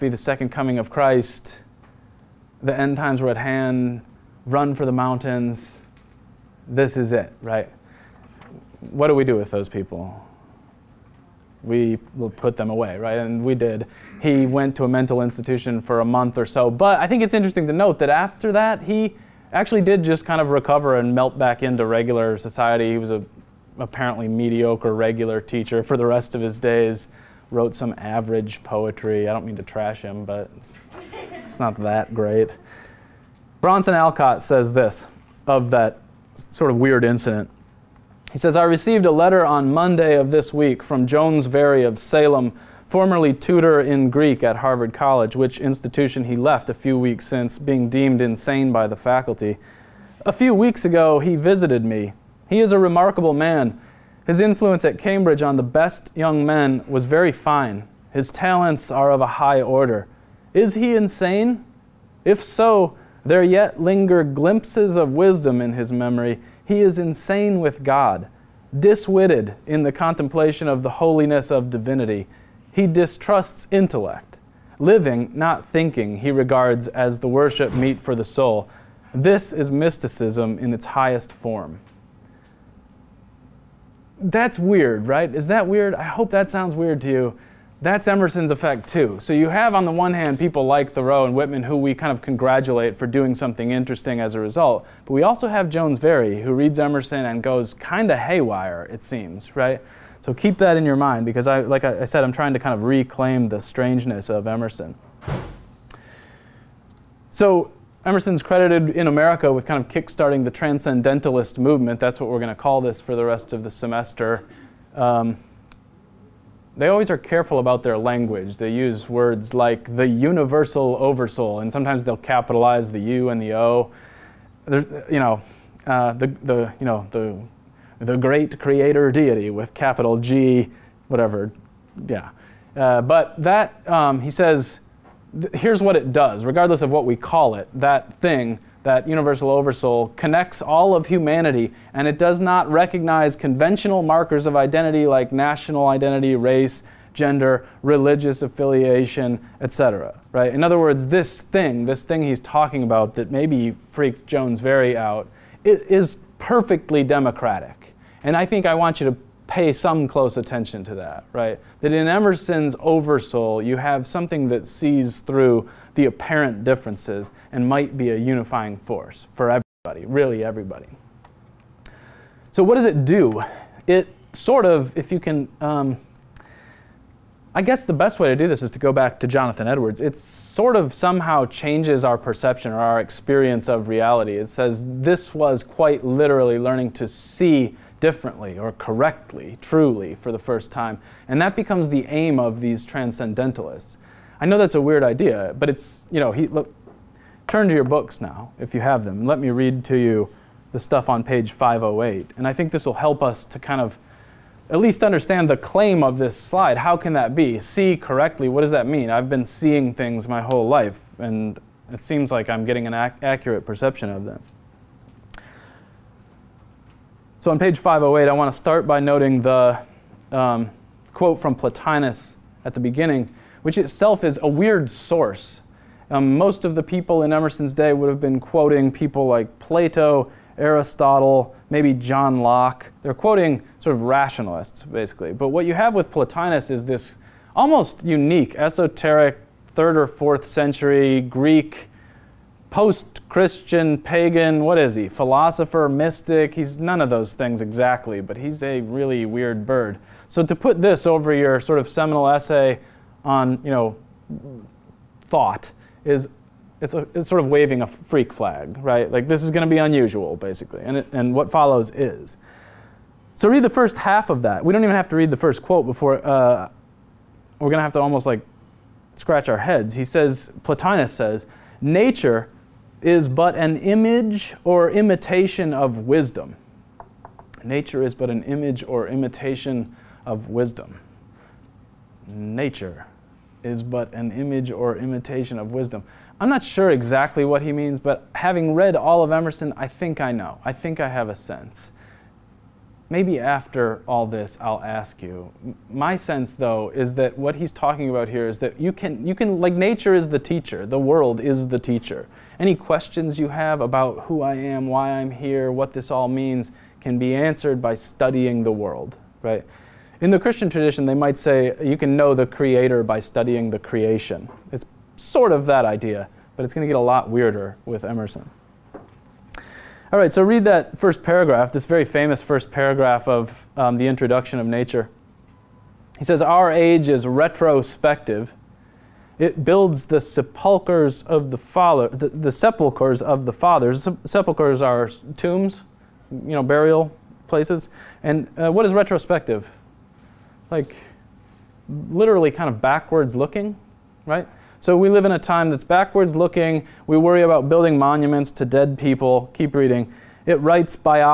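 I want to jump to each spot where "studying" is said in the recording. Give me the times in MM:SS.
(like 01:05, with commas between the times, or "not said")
05:07, 05:13.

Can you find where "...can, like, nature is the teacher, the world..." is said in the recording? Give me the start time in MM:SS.
04:59.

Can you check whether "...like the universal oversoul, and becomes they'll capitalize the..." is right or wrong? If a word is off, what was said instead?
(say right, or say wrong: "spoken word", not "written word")
wrong: "sometimes", not "becomes".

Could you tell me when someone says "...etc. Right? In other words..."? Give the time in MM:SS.
02:29.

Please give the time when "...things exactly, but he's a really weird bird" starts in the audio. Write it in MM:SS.
04:07.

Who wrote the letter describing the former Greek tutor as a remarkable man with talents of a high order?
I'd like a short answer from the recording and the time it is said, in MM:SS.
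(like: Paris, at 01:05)
Bronson Alcott, at 00:33.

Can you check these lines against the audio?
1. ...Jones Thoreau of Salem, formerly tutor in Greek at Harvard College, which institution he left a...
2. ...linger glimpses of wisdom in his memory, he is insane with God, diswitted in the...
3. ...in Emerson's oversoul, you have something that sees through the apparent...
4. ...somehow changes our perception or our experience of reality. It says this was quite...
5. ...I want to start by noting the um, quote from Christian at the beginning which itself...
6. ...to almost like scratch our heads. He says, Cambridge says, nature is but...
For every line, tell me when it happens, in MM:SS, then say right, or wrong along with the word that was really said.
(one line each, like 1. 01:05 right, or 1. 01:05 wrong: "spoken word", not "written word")
1. 00:41 wrong: "Very", not "Thoreau"
2. 01:03 right
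3. 02:41 right
4. 03:00 right
5. 03:38 wrong: "Plotinus", not "Christian"
6. 04:27 wrong: "Plotinus", not "Cambridge".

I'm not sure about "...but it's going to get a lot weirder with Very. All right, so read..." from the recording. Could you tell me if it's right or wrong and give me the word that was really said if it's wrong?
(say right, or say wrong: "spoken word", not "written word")
wrong: "Emerson", not "Very".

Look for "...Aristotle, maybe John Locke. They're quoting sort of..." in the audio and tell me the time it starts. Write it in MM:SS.
03:50.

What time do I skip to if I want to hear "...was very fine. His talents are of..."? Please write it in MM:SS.
00:56.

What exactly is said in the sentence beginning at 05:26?
He says, Our age is retrospective.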